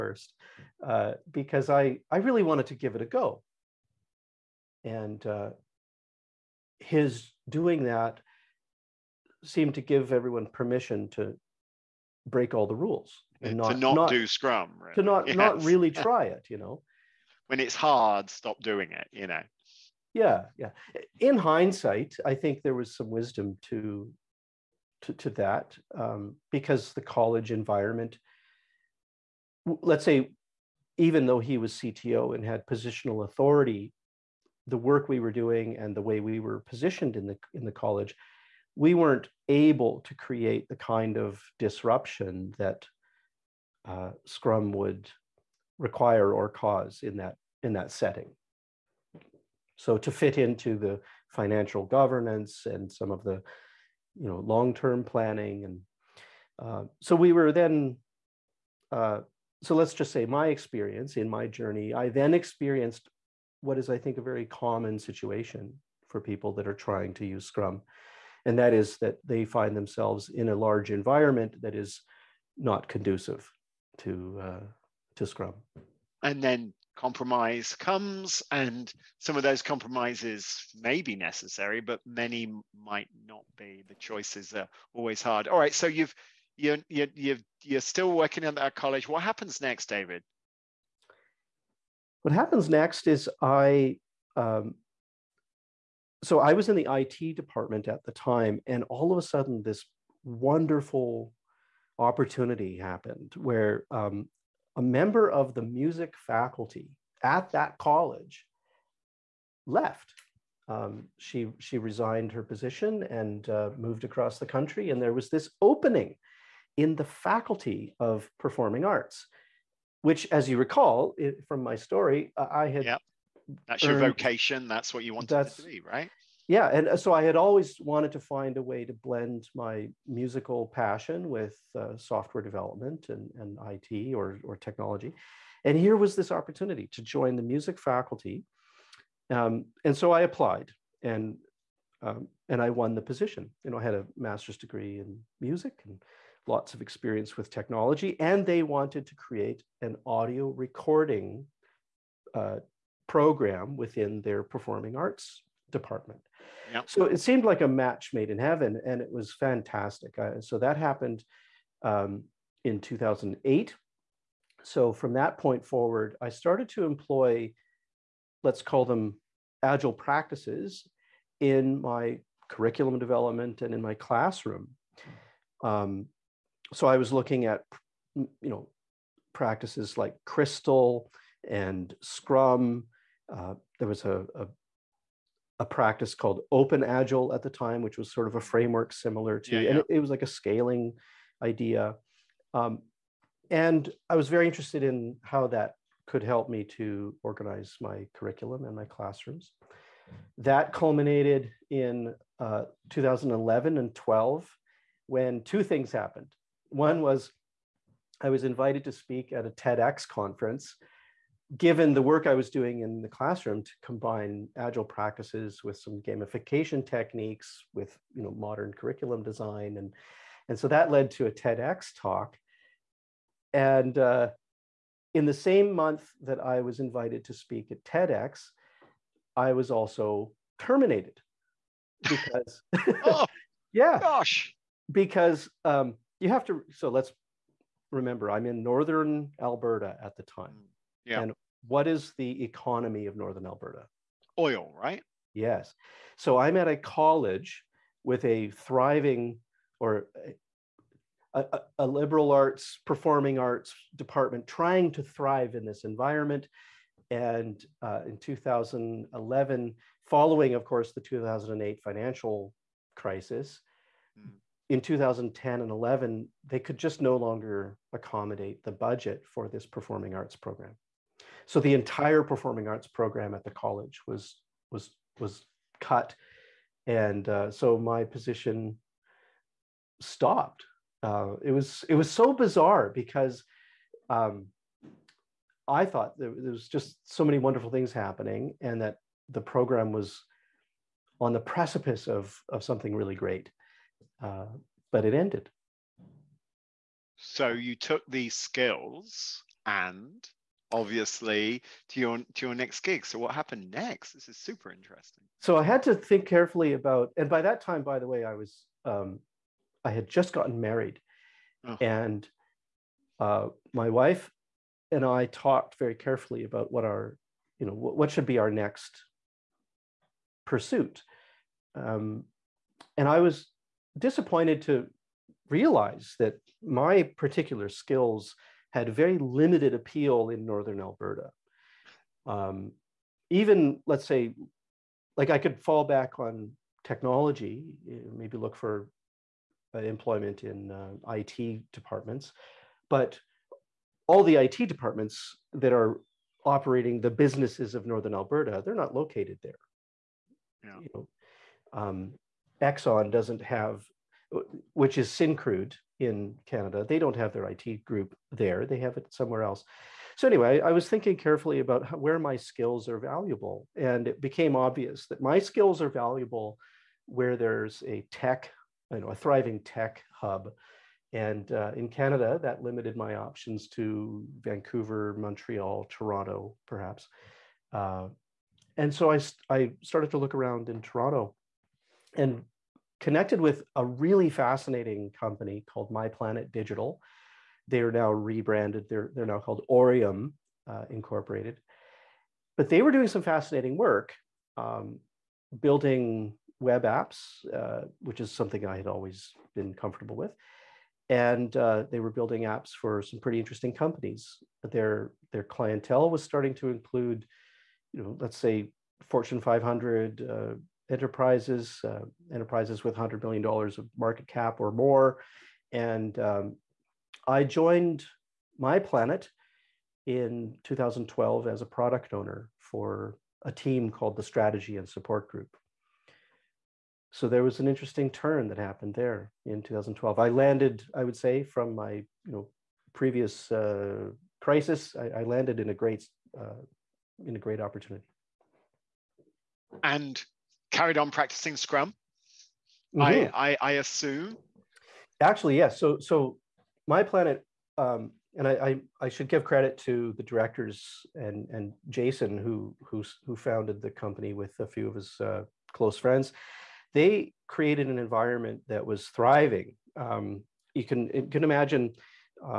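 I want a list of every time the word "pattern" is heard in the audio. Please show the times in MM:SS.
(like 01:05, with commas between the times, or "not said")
not said.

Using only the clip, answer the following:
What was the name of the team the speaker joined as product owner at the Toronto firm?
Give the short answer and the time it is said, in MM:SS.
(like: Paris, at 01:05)
Strategy and Support Group, at 07:04.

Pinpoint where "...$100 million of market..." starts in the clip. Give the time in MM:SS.
06:52.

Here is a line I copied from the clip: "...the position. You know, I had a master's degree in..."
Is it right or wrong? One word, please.
right.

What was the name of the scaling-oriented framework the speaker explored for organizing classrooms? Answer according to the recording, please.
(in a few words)
Open Agile.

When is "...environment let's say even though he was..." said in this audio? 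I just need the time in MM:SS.
00:27.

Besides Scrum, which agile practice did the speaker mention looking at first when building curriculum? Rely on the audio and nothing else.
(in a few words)
Crystal.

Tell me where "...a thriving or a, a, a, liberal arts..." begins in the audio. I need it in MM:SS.
04:08.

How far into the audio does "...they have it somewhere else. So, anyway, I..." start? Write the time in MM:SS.
05:58.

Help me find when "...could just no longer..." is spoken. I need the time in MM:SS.
04:26.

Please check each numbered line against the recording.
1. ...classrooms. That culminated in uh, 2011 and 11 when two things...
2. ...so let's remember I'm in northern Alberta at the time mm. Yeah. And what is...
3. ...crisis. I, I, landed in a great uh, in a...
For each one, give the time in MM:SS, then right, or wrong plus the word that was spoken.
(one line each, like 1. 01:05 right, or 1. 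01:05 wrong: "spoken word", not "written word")
1. 03:18 wrong: "12", not "11"
2. 03:56 right
3. 07:14 right.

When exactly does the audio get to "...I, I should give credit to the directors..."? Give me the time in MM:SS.
07:28.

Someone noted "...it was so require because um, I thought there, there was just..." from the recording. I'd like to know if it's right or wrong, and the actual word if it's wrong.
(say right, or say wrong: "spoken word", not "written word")
wrong: "bizarre", not "require".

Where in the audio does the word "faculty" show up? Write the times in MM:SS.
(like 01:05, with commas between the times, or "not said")
01:46, 01:57, 02:17.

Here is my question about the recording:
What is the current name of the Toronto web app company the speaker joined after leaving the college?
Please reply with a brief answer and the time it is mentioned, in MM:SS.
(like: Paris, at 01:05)
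Orium, at 06:29.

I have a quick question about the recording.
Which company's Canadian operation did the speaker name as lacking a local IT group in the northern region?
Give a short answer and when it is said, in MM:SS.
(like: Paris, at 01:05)
Syncrude, at 05:55.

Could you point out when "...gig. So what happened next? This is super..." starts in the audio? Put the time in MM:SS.
05:02.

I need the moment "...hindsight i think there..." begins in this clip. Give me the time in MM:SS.
00:21.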